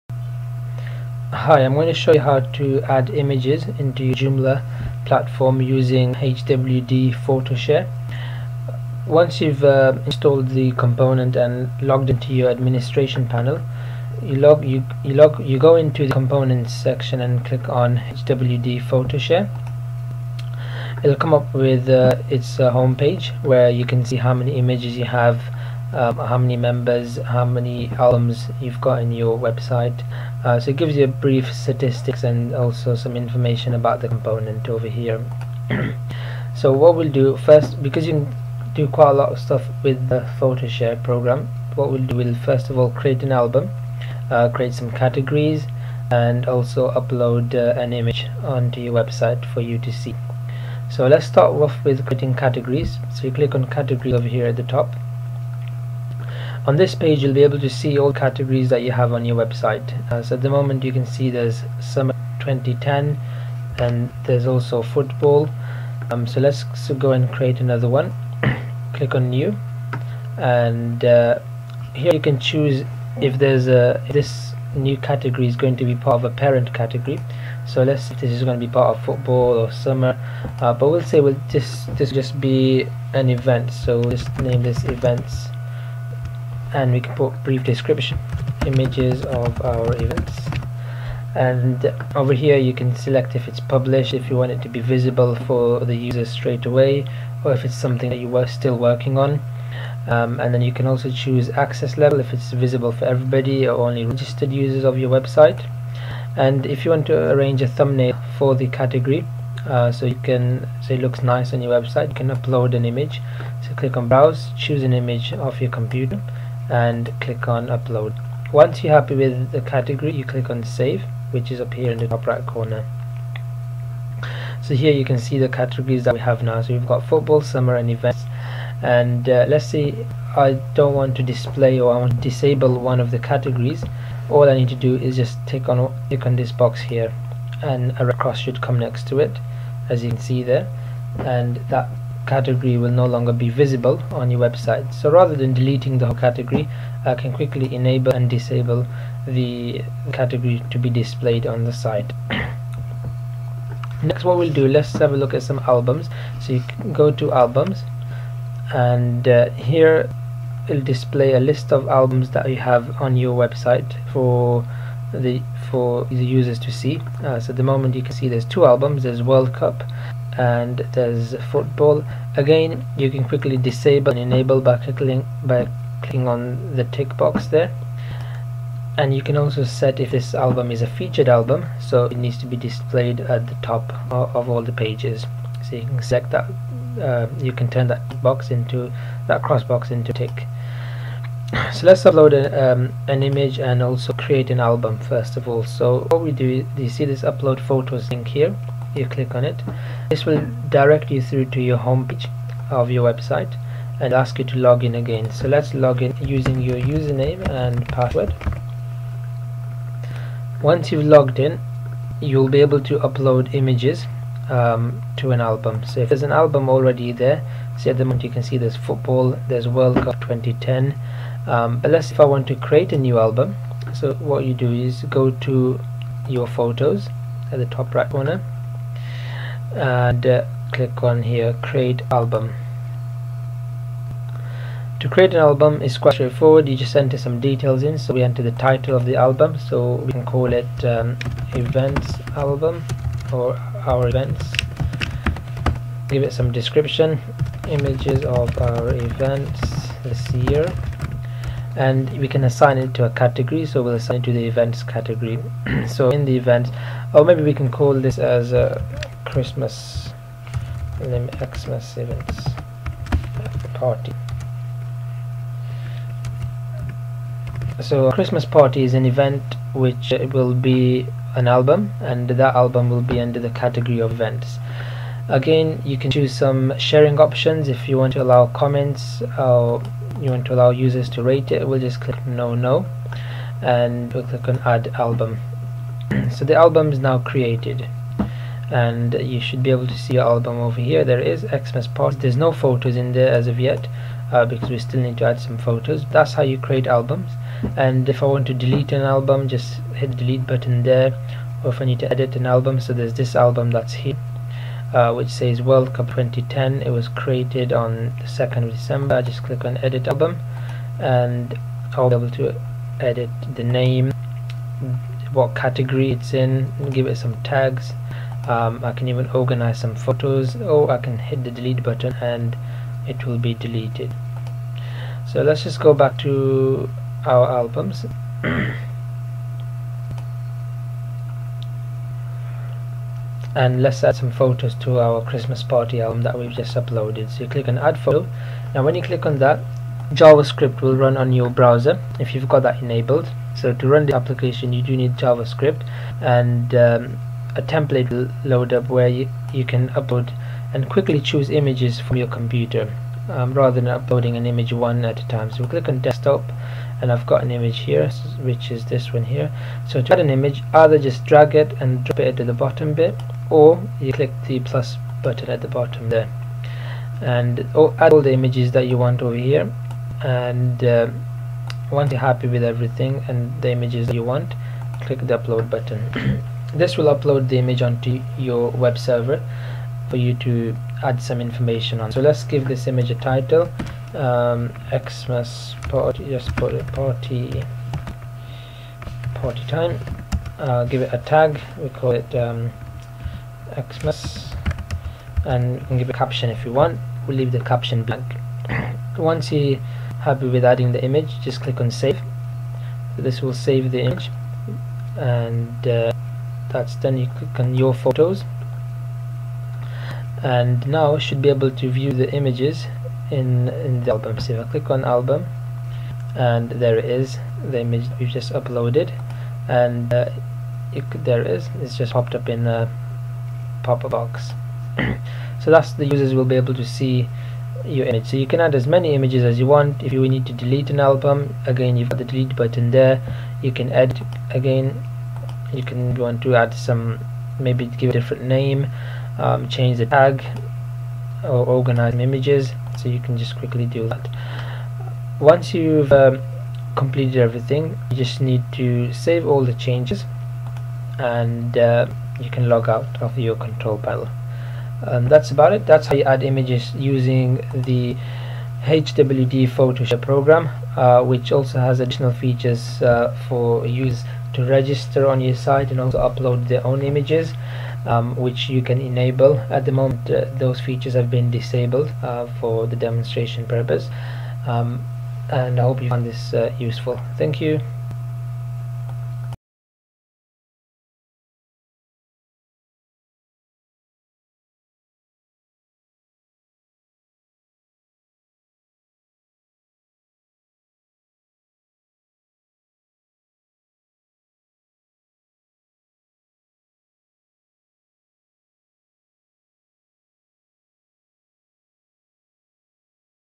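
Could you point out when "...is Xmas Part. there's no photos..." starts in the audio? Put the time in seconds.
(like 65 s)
291 s.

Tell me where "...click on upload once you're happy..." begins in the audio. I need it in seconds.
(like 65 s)
117 s.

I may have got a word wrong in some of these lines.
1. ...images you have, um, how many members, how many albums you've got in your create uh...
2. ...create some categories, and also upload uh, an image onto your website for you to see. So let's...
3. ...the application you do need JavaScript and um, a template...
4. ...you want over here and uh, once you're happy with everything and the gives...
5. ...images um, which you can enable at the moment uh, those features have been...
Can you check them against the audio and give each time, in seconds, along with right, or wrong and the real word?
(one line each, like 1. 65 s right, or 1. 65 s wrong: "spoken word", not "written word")
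1. 24 s wrong: "website", not "create"
2. 44 s right
3. 344 s right
4. 368 s wrong: "images", not "gives"
5. 467 s right.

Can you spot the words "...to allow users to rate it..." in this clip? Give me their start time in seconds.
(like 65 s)
280 s.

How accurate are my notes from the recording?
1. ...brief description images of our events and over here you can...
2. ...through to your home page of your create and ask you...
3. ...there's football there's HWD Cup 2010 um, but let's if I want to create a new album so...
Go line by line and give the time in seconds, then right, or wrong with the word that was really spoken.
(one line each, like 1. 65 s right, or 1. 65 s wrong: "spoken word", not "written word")
1. 87 s right
2. 201 s wrong: "website", not "create"
3. 218 s wrong: "World", not "HWD".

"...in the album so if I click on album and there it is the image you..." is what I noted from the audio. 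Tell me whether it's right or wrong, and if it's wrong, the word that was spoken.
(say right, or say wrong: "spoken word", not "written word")
right.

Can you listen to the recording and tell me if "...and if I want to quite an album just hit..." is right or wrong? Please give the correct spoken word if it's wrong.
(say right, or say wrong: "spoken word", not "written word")
wrong: "delete", not "quite".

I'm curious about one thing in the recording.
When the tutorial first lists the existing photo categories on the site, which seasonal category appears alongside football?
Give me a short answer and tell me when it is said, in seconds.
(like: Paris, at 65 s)
Summer 2010, at 61 s.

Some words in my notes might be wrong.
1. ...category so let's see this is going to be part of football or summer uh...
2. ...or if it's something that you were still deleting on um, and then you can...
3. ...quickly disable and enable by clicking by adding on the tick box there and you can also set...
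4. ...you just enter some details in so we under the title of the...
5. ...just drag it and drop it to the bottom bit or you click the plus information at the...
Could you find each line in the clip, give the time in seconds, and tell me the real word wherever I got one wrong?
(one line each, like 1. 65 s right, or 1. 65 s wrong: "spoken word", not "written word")
1. 76 s right
2. 97 s wrong: "working", not "deleting"
3. 173 s wrong: "clicking", not "adding"
4. 236 s wrong: "enter", not "under"
5. 360 s wrong: "button", not "information".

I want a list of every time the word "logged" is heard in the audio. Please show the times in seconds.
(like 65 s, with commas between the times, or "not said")
11 s, 211 s.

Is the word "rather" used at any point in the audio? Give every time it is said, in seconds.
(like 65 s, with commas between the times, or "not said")
145 s, 353 s.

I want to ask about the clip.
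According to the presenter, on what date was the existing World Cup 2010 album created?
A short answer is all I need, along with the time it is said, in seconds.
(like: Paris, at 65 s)
2nd of December, at 308 s.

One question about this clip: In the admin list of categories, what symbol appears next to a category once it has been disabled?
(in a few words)
A red cross.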